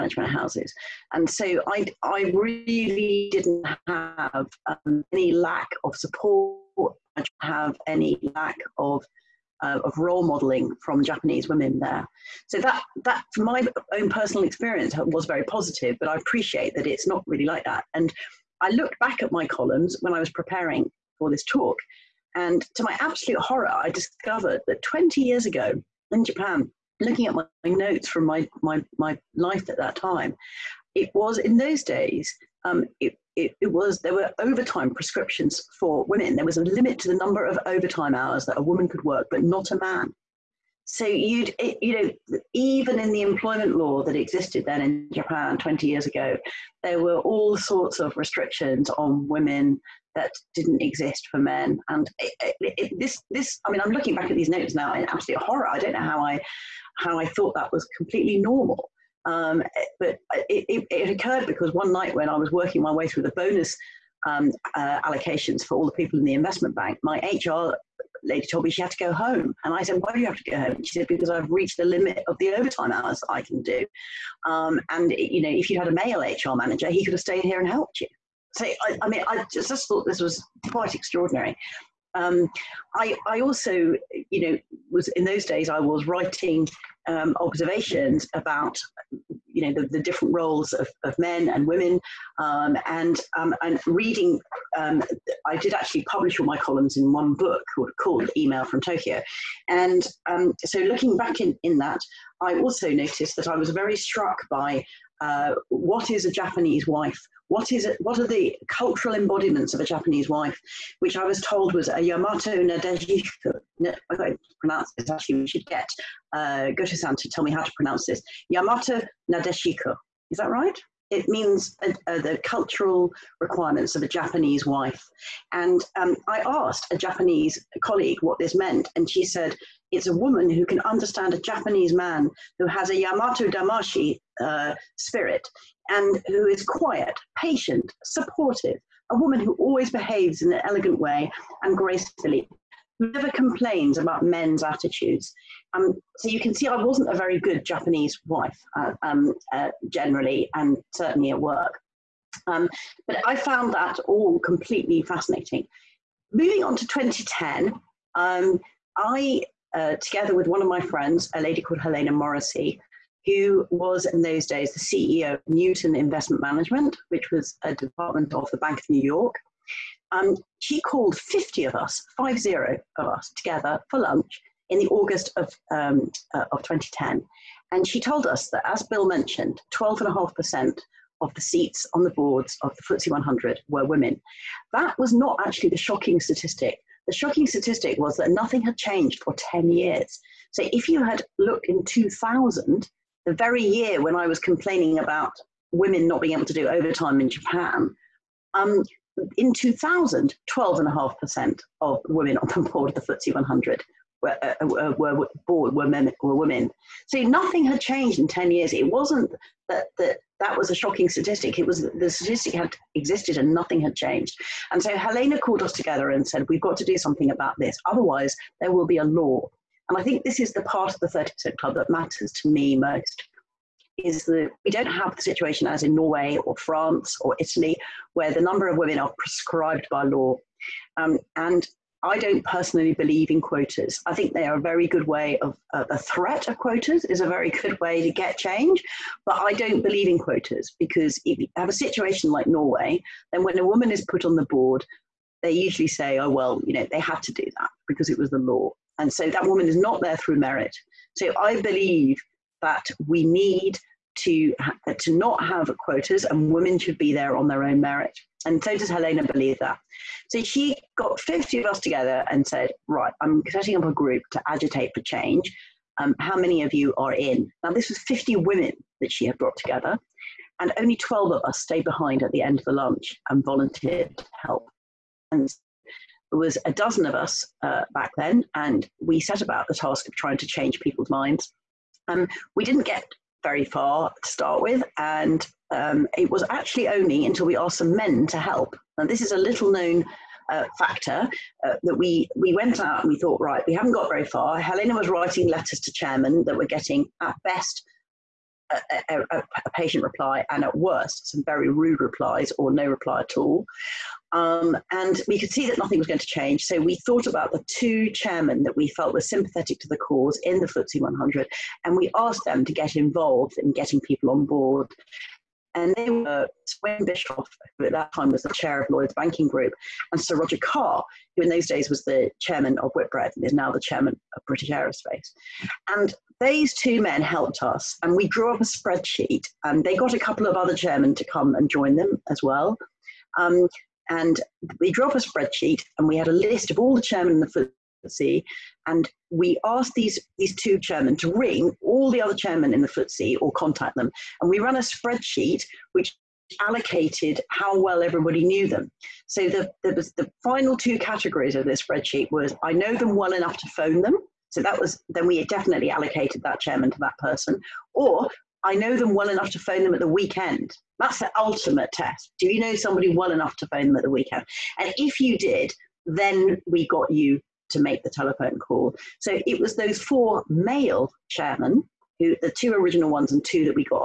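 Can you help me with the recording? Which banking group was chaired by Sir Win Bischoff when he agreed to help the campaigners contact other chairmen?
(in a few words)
Lloyd's Banking Group.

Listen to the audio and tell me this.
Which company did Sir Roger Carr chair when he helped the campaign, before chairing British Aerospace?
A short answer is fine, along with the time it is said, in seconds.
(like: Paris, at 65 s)
Whitbread, at 322 s.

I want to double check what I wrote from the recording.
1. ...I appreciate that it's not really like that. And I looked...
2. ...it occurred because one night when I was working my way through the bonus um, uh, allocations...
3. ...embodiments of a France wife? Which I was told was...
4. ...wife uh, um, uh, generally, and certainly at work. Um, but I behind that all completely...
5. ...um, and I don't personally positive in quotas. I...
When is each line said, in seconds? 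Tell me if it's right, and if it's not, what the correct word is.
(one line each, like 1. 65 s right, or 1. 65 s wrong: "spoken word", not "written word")
1. 16 s right
2. 60 s right
3. 109 s wrong: "Japanese", not "France"
4. 148 s wrong: "found", not "behind"
5. 230 s wrong: "believe", not "positive".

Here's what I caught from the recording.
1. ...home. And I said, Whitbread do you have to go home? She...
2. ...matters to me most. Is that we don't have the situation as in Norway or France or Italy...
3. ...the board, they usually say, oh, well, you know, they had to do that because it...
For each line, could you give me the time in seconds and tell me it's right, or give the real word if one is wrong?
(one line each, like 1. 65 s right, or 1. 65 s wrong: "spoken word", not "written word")
1. 69 s wrong: "Why", not "Whitbread"
2. 221 s right
3. 244 s right.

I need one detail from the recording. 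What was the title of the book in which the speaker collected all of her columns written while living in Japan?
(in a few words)
Email from Tokyo.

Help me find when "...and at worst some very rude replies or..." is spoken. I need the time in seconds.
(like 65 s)
300 s.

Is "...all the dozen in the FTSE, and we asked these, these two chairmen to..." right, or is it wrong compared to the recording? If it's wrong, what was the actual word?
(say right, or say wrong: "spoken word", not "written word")
wrong: "chairmen", not "dozen".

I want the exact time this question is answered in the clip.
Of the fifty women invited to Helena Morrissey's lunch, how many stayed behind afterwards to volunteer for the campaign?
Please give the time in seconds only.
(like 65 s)
270 s.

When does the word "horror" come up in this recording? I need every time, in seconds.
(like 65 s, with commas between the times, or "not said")
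23 s, 55 s.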